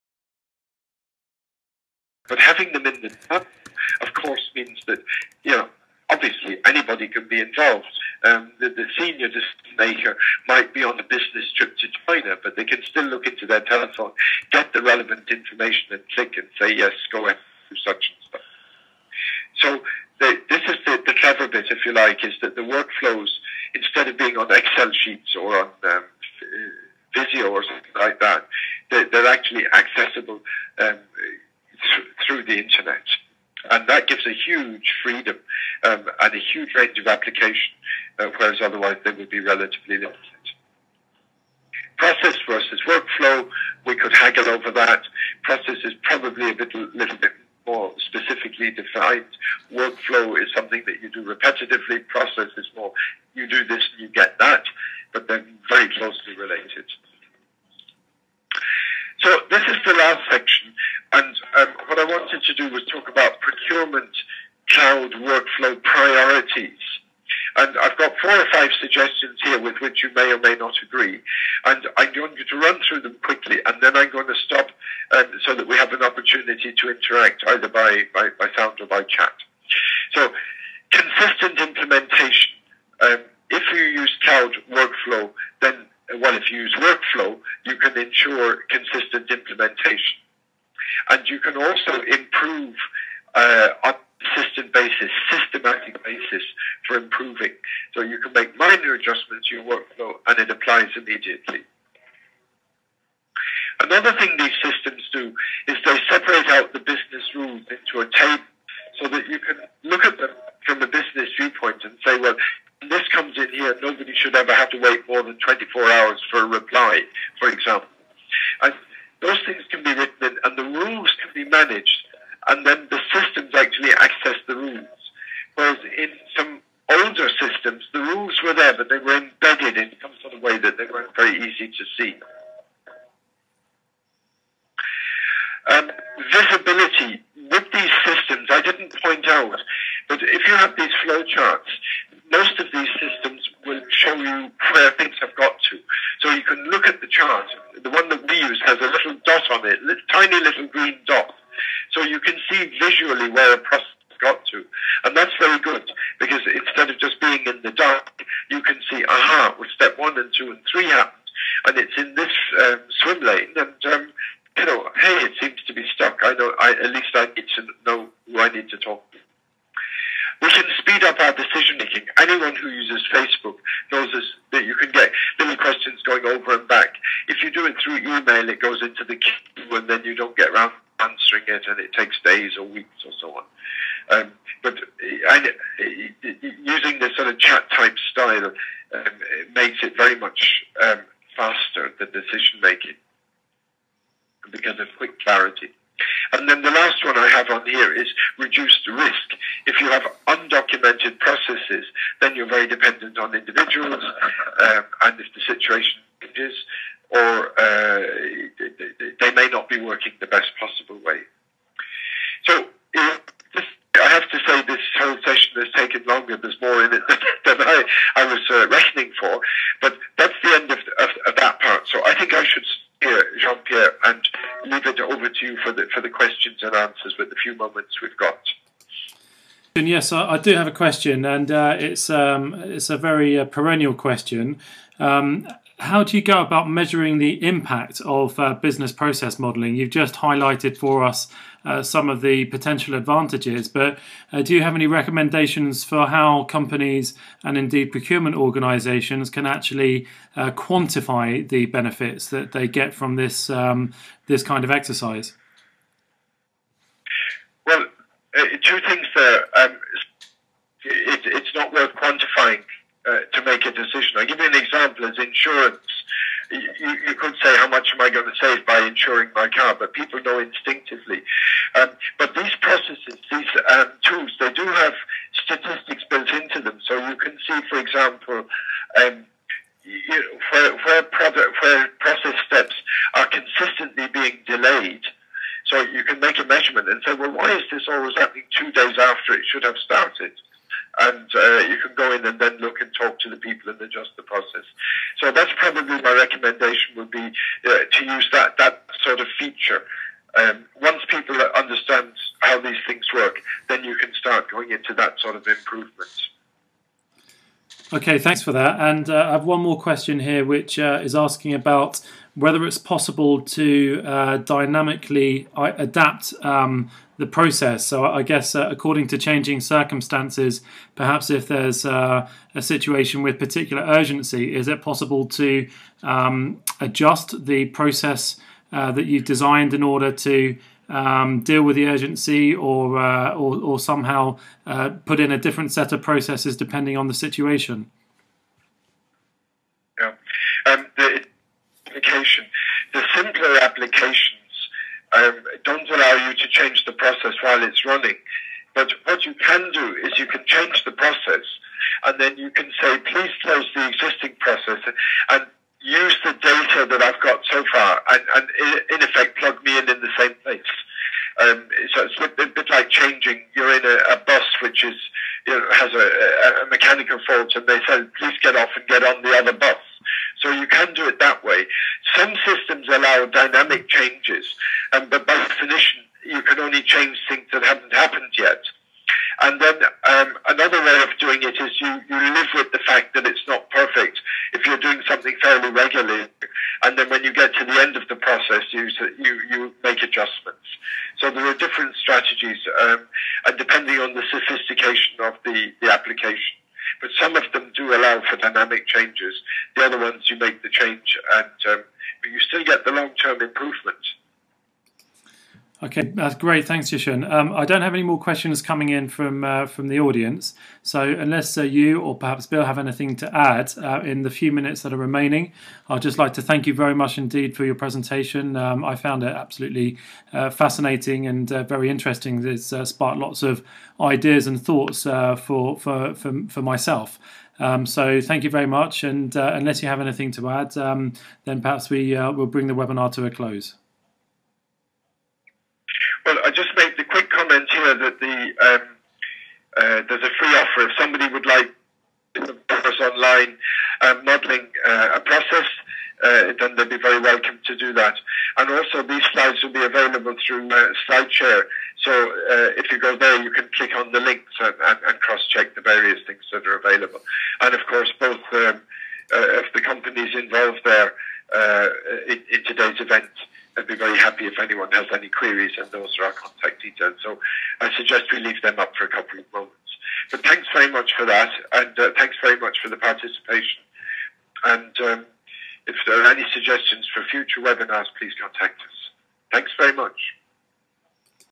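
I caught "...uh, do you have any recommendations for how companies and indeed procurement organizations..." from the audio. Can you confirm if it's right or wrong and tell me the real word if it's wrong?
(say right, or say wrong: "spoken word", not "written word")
right.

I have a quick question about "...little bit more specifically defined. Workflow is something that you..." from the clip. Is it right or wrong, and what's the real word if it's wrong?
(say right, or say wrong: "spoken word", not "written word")
right.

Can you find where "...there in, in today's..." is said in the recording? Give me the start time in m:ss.
7:40.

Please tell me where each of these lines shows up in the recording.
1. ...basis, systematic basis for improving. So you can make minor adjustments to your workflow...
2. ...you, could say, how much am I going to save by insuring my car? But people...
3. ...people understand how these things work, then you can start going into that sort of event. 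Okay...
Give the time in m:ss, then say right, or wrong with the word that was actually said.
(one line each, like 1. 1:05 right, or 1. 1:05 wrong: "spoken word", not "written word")
1. 1:34 right
2. 4:27 right
3. 5:01 wrong: "improvement", not "event".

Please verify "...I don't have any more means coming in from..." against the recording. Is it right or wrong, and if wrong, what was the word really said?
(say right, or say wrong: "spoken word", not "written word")
wrong: "questions", not "means".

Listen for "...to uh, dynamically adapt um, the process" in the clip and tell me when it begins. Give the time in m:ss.
5:13.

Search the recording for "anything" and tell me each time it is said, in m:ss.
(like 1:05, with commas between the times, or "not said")
6:52, 7:09.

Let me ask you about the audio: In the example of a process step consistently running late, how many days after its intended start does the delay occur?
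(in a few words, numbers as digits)
2.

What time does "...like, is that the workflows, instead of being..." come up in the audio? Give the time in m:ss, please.
0:21.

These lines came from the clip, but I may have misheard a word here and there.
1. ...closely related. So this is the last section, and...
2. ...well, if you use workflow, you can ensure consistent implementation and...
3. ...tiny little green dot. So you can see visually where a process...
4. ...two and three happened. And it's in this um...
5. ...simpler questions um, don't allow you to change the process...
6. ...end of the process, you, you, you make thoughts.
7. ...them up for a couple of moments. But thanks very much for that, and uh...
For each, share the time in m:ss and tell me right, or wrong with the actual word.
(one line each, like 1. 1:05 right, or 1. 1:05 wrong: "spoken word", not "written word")
1. 0:55 right
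2. 1:26 right
3. 2:30 right
4. 2:40 right
5. 5:43 wrong: "applications", not "questions"
6. 6:27 wrong: "adjustments", not "thoughts"
7. 7:48 right.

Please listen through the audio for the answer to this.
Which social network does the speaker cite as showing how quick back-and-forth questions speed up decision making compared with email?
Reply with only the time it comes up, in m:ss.
2:53.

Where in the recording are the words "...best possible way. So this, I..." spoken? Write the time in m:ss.
3:30.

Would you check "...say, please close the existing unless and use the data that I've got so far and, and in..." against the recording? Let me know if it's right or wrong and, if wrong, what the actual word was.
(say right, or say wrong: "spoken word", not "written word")
wrong: "process", not "unless".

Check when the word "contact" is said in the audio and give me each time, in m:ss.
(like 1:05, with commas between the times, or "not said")
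7:46, 7:58.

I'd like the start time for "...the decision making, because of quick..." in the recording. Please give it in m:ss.
3:11.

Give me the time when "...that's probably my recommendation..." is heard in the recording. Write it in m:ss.
4:55.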